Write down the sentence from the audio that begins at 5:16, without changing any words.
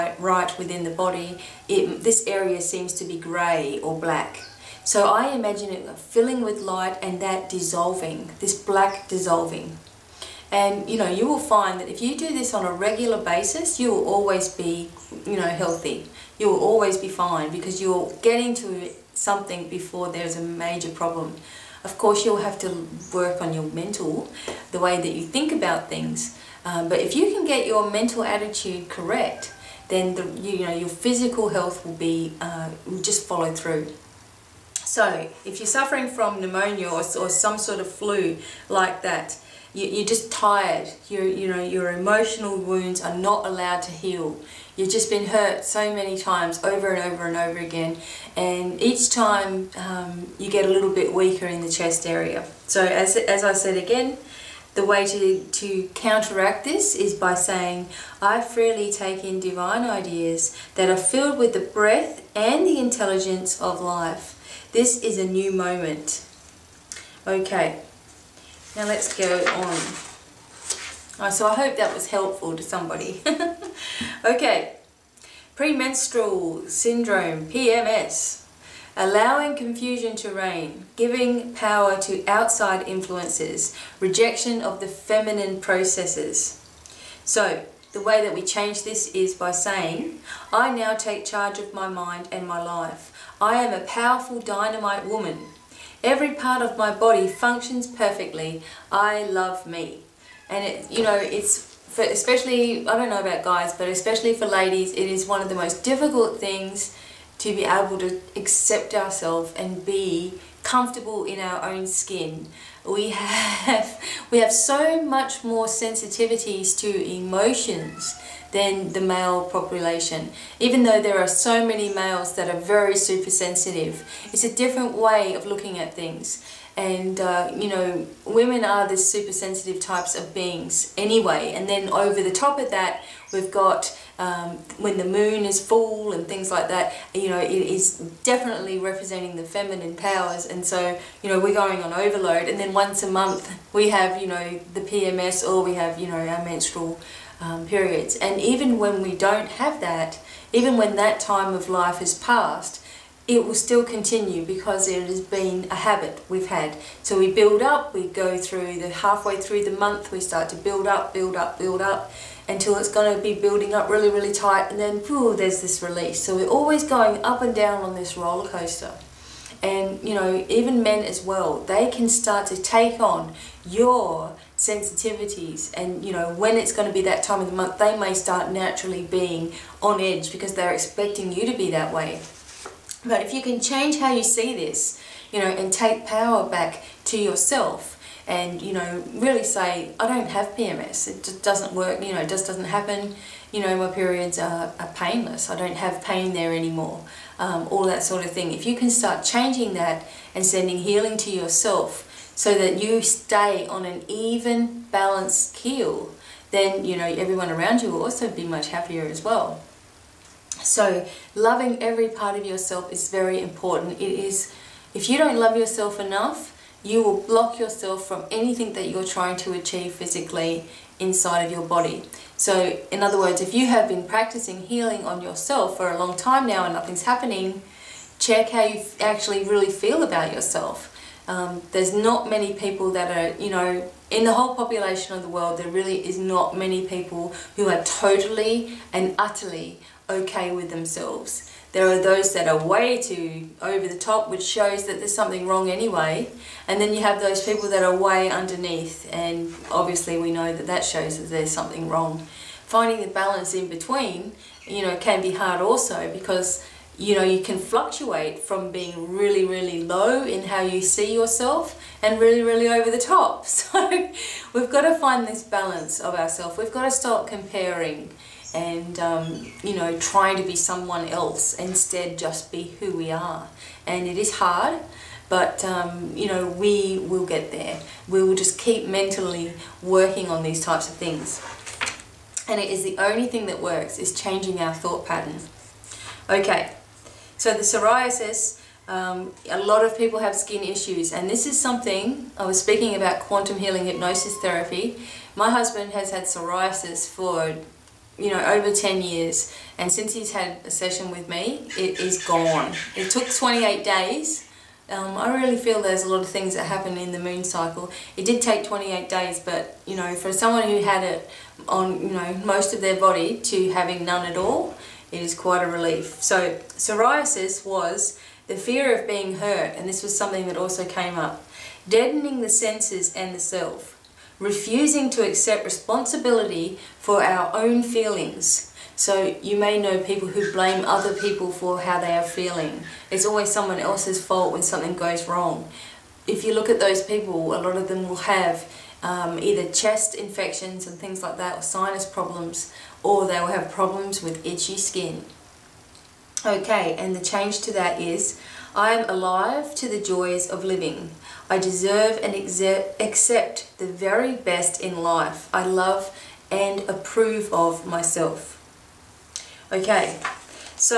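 So psoriasis was the fear of being hurt, and this was something that also came up.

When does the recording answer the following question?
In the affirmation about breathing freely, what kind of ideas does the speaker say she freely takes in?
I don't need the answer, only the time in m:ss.
0:59.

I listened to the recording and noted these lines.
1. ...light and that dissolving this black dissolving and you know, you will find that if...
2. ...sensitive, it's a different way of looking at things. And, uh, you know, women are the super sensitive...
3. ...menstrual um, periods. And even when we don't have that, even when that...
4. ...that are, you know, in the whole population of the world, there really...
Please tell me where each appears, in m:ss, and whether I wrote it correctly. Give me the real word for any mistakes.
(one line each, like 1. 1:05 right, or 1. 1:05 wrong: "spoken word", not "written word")
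1. 0:06 right
2. 2:03 right
3. 2:26 right
4. 3:52 right.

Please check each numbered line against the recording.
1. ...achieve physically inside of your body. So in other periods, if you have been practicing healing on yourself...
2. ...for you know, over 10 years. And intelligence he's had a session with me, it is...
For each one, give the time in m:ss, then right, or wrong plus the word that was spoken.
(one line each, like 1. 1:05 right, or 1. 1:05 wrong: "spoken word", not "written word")
1. 3:39 wrong: "words", not "periods"
2. 4:57 wrong: "since", not "intelligence".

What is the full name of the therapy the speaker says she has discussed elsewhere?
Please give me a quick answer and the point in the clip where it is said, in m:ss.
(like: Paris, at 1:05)
quantum healing hypnosis therapy, at 4:53.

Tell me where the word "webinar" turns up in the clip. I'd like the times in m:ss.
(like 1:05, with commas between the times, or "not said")
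not said.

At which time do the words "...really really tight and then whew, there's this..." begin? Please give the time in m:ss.
2:43.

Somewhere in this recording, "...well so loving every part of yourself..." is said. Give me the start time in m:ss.
3:29.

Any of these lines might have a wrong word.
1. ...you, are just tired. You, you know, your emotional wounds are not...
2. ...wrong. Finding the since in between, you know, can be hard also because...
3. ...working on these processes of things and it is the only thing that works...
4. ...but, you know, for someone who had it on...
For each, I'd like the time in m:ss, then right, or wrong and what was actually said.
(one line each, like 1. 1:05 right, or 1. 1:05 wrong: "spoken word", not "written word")
1. 0:39 right
2. 4:11 wrong: "balance", not "since"
3. 4:39 wrong: "types", not "processes"
4. 5:09 right.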